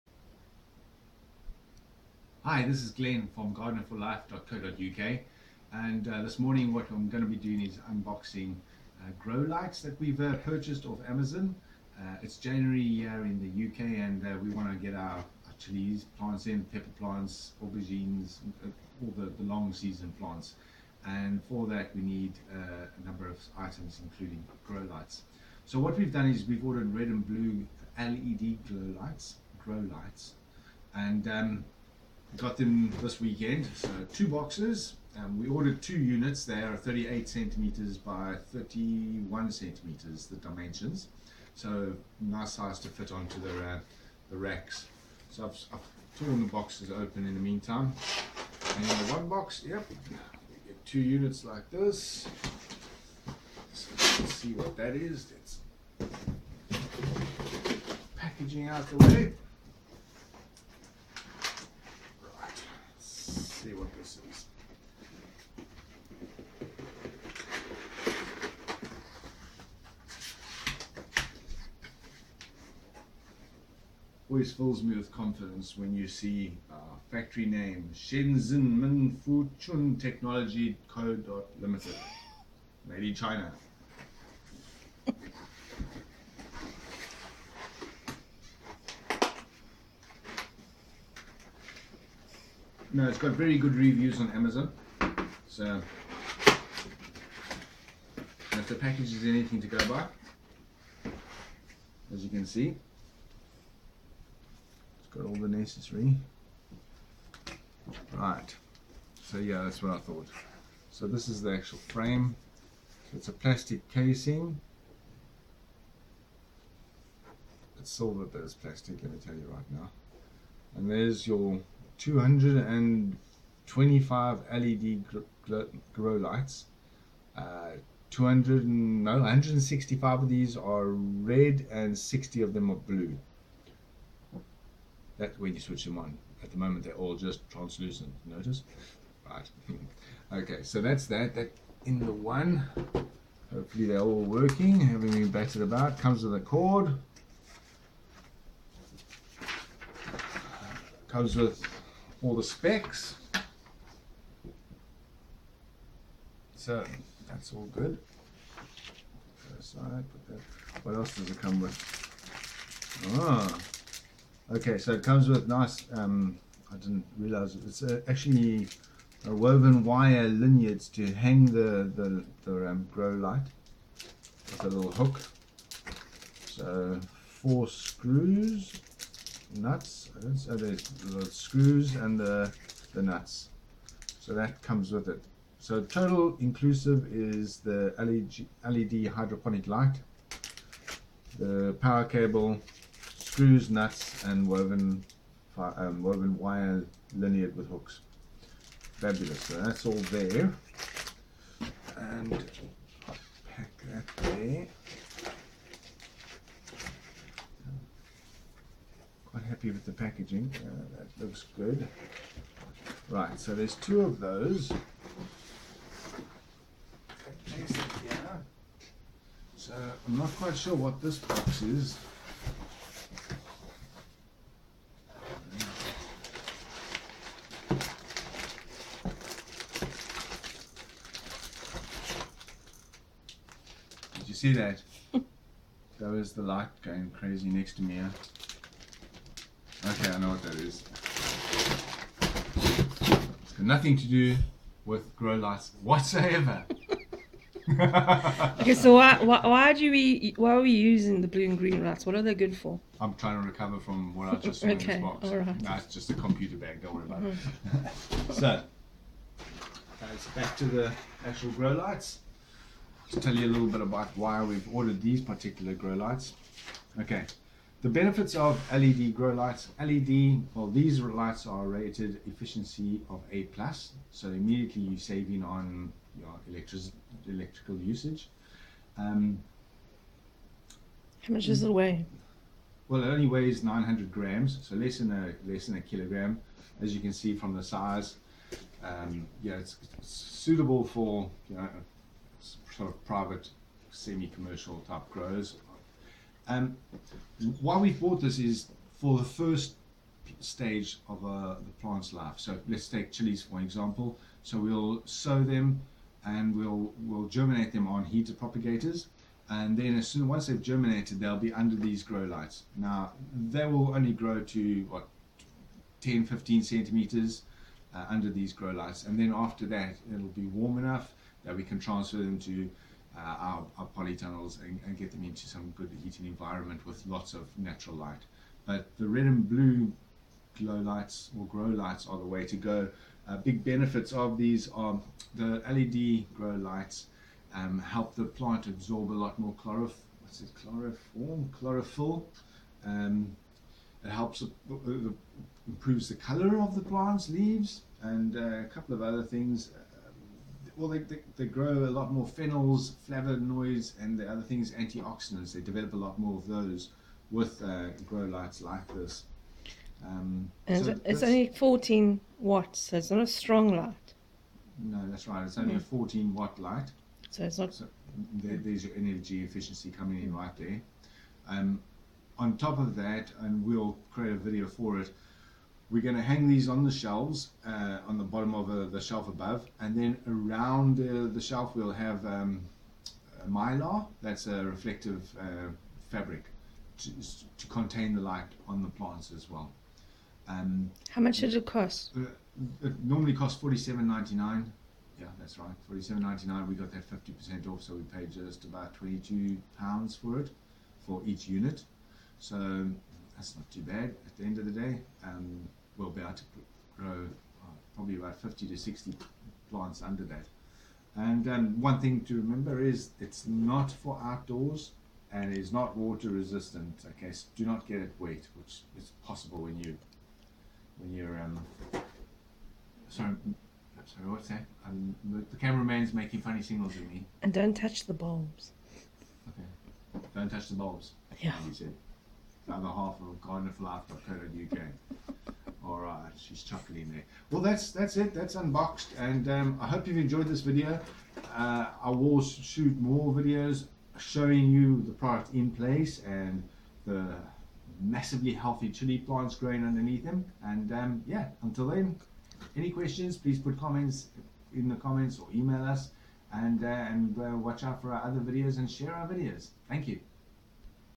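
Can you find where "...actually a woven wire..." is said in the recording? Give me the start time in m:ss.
2:48.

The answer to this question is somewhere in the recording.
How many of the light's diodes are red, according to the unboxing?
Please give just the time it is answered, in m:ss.
2:09.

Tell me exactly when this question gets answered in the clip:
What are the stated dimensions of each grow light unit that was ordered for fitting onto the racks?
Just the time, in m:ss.
0:36.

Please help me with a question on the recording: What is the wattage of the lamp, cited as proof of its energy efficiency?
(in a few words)
14 watts.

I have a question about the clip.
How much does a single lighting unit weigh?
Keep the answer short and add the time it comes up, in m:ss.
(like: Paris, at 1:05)
900 grams, at 4:43.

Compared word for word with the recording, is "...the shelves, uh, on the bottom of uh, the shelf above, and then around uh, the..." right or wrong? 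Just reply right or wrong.
right.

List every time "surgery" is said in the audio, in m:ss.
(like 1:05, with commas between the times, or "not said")
not said.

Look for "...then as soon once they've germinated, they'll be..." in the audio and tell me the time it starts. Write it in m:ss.
5:09.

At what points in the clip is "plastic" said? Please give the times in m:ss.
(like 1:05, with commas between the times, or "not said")
1:53, 1:58.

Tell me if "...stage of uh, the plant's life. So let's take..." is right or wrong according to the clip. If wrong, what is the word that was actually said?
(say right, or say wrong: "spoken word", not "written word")
right.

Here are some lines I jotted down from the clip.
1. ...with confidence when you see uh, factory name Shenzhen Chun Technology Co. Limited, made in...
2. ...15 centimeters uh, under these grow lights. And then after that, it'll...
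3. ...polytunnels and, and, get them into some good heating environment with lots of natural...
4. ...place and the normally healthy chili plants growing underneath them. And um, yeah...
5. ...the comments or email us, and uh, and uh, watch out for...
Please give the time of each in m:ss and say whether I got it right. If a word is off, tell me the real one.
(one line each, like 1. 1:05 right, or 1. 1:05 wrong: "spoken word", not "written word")
1. 1:14 right
2. 5:16 right
3. 5:23 right
4. 7:25 wrong: "massively", not "normally"
5. 7:34 right.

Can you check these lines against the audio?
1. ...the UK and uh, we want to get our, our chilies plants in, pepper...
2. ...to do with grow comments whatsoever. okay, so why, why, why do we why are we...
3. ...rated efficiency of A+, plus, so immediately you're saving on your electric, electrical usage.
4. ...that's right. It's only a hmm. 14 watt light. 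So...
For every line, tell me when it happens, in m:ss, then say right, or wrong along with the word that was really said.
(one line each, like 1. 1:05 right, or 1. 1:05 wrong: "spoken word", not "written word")
1. 0:13 right
2. 4:03 wrong: "lights", not "comments"
3. 4:31 right
4. 6:05 right.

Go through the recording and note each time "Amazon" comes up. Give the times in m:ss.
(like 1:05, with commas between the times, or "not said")
0:11, 1:34.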